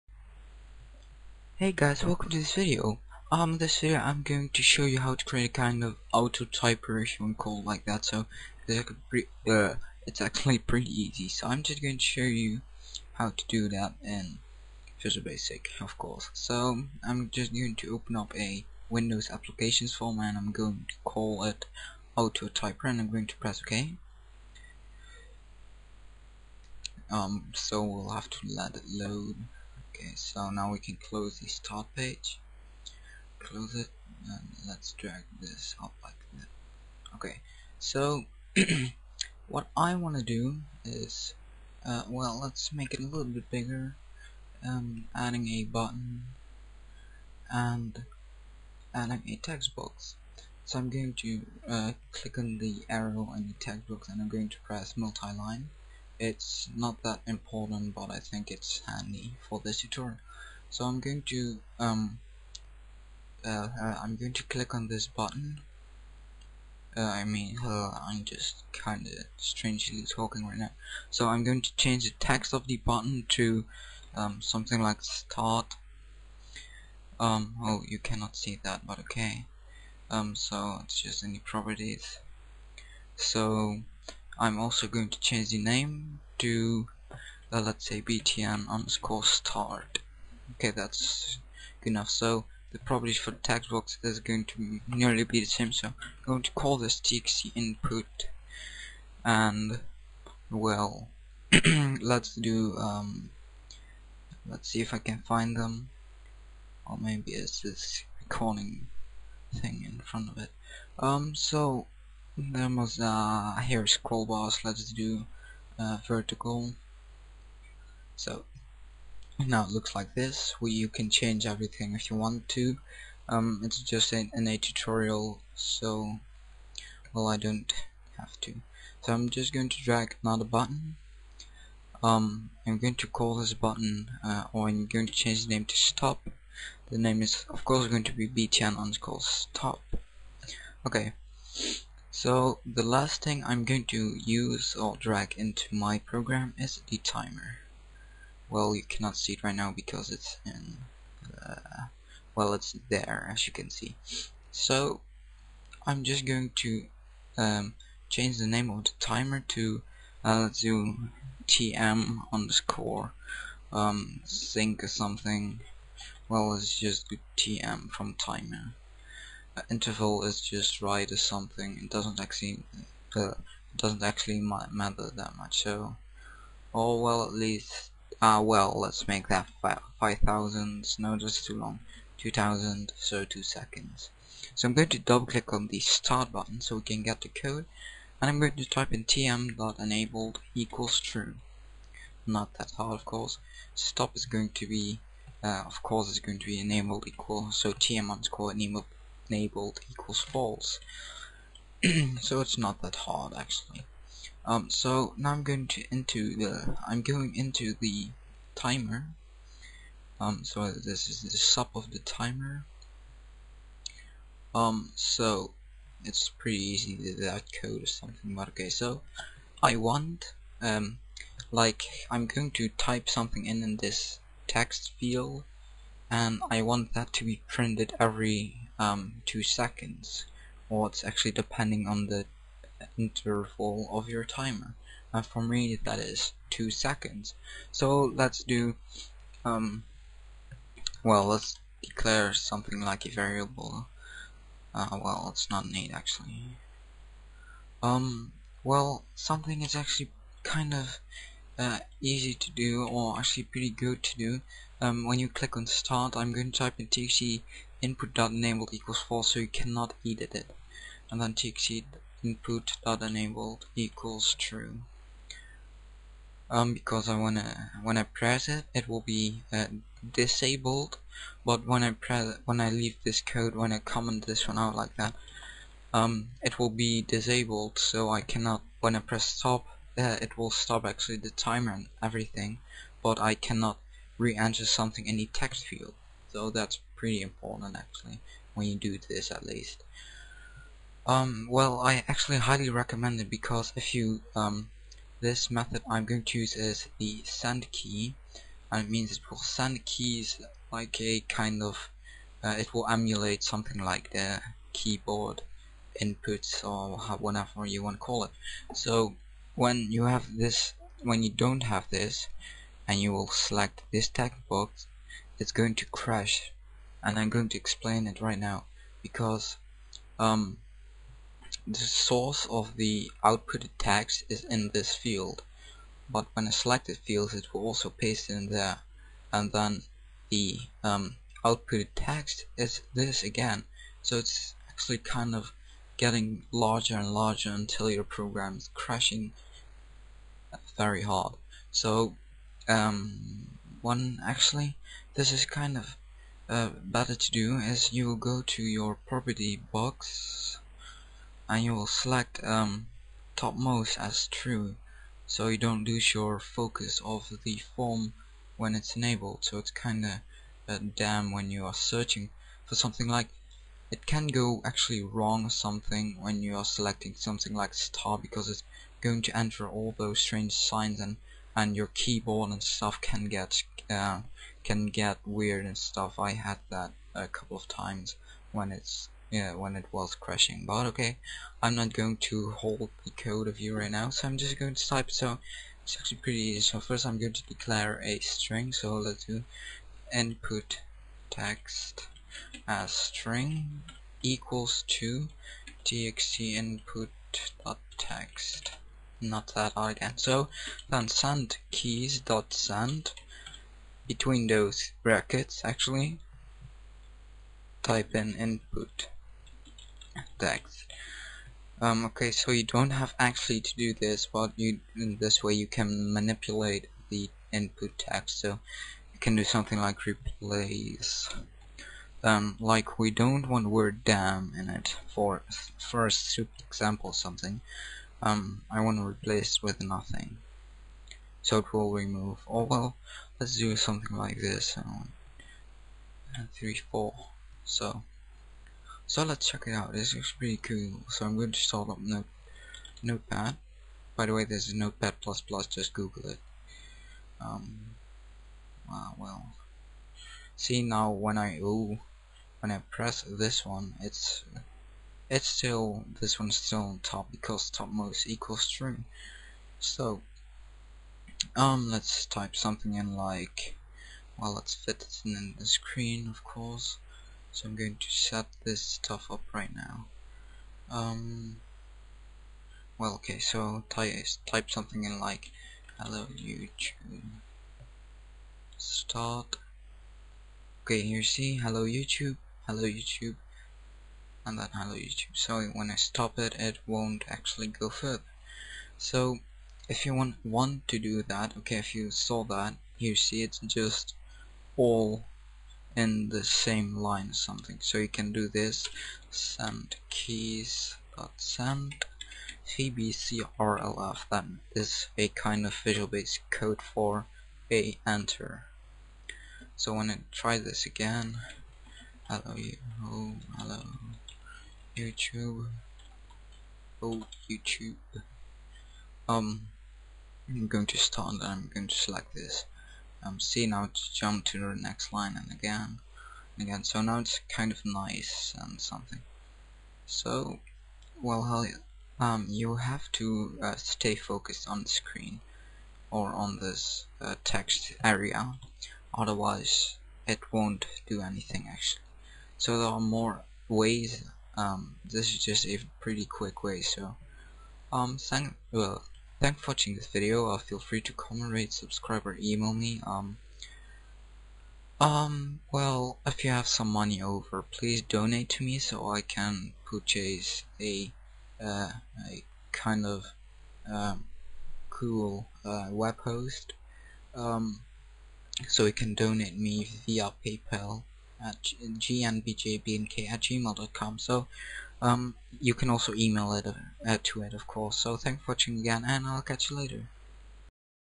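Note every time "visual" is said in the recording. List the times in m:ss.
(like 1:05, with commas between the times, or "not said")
0:15, 8:25.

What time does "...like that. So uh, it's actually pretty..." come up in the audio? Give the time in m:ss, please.
0:07.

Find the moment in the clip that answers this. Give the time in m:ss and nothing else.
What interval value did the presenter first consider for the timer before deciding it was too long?
2:59.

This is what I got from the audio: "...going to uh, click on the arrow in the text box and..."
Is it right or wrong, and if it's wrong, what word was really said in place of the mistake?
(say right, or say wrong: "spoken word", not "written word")
right.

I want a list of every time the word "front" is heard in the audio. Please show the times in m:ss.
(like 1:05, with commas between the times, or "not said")
1:49.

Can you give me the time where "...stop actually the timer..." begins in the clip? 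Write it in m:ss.
4:40.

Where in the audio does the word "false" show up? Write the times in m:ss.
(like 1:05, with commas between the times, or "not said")
3:20, 4:18.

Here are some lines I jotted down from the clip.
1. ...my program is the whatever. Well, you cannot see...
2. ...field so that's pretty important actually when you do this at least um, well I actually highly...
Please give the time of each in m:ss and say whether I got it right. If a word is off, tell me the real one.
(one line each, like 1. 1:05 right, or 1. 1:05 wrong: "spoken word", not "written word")
1. 2:25 wrong: "timer", not "whatever"
2. 4:45 right.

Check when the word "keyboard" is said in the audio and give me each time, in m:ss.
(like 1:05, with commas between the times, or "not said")
5:04, 6:11.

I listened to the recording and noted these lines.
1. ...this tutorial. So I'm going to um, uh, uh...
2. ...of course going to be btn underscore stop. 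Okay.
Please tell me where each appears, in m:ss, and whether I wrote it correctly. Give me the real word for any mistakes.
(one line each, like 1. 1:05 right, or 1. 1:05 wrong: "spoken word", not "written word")
1. 0:59 right
2. 2:17 right.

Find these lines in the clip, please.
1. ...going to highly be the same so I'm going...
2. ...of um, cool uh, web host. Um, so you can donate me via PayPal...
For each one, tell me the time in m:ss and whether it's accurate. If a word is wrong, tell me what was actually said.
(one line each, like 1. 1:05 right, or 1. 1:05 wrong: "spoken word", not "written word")
1. 1:34 wrong: "nearly", not "highly"
2. 9:23 right.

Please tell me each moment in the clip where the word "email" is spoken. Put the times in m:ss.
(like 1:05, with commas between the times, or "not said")
9:12, 9:36.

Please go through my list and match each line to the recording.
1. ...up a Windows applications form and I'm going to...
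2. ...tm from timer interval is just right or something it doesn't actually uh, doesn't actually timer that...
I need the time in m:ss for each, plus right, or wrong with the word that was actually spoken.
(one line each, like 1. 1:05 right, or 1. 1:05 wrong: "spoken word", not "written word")
1. 0:18 right
2. 2:47 wrong: "matter", not "timer".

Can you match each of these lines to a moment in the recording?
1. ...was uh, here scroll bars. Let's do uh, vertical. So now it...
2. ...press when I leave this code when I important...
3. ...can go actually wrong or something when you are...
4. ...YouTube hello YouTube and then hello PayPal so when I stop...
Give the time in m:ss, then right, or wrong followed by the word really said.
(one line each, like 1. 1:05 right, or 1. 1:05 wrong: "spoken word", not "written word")
1. 1:52 right
2. 4:31 wrong: "comment", not "important"
3. 6:04 right
4. 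8:01 wrong: "YouTube", not "PayPal".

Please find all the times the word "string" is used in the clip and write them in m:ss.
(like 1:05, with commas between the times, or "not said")
6:28, 6:32.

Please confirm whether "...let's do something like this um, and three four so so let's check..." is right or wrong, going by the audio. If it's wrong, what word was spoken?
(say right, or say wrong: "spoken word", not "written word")
right.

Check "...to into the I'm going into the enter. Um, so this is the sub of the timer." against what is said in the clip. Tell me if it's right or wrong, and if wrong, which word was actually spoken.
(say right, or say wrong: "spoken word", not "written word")
wrong: "timer", not "enter".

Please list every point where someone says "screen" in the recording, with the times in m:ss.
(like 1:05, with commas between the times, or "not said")
7:45, 8:54.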